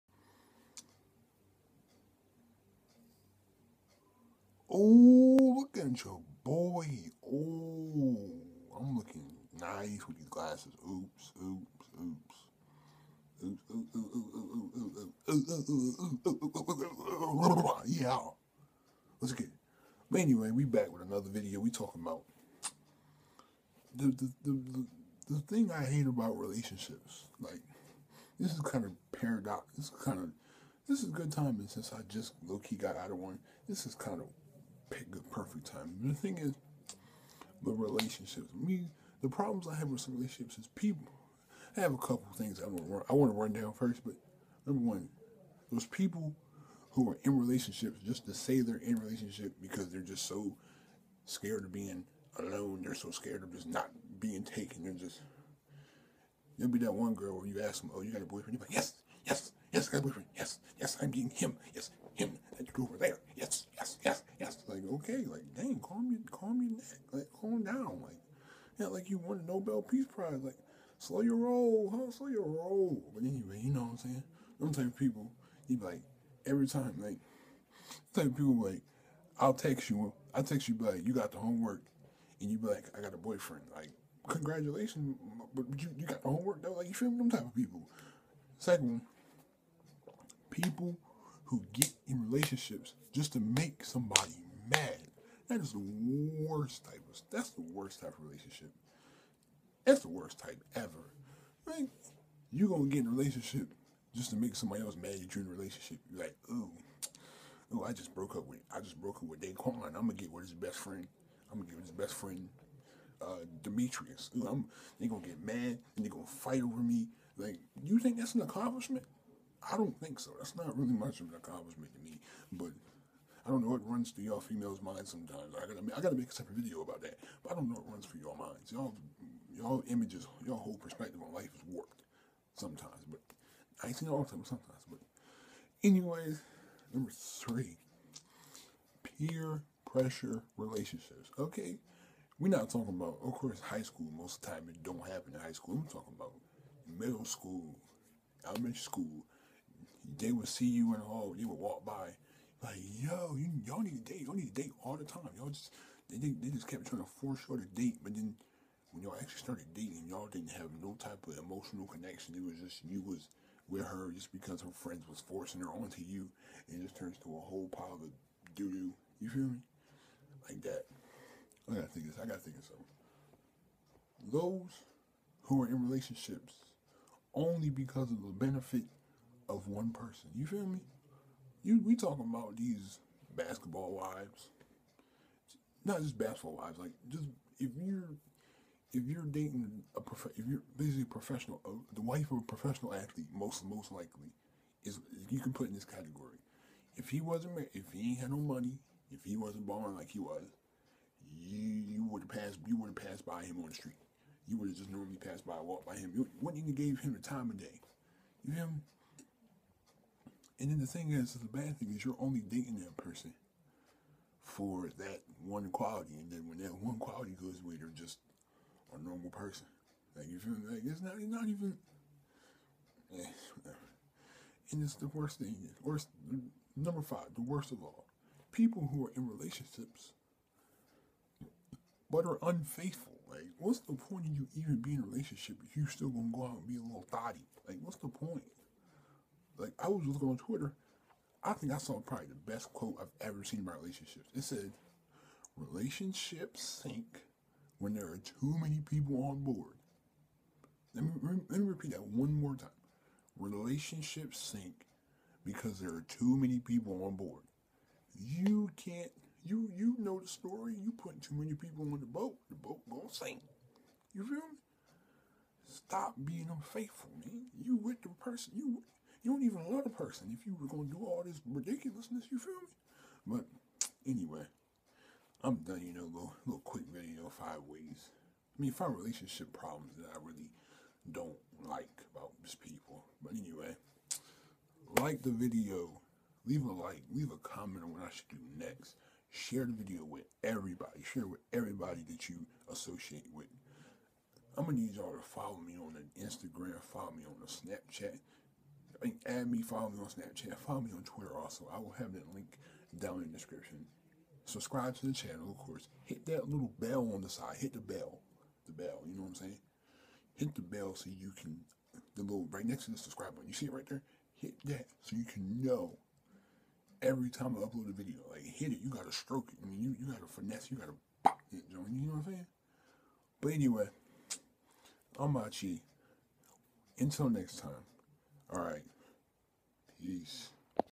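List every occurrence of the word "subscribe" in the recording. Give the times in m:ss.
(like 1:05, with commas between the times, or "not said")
5:04, 5:12.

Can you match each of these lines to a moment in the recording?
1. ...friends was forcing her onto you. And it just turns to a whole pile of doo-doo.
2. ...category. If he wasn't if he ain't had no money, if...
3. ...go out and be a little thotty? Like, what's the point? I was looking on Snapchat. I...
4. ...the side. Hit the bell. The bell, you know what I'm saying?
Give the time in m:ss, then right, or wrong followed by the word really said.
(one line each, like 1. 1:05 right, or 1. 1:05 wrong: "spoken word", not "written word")
1. 2:44 right
2. 3:15 right
3. 3:56 wrong: "Twitter", not "Snapchat"
4. 5:07 right.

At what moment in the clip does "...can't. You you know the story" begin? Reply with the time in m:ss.
4:18.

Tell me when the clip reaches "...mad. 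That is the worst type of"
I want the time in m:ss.
1:34.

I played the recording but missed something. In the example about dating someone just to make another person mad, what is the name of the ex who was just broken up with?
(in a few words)
Daquan.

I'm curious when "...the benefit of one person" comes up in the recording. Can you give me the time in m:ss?
2:58.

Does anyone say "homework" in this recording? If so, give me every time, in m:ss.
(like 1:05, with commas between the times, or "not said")
1:21, 1:26.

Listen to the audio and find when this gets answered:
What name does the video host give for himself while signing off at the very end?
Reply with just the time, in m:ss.
5:25.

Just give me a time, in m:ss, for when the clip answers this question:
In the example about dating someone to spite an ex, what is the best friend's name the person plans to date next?
1:53.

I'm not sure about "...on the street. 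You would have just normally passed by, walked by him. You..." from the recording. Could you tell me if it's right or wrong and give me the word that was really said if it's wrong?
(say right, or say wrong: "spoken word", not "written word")
right.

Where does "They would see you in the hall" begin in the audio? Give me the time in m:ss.
2:30.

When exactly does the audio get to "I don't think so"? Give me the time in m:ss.
1:59.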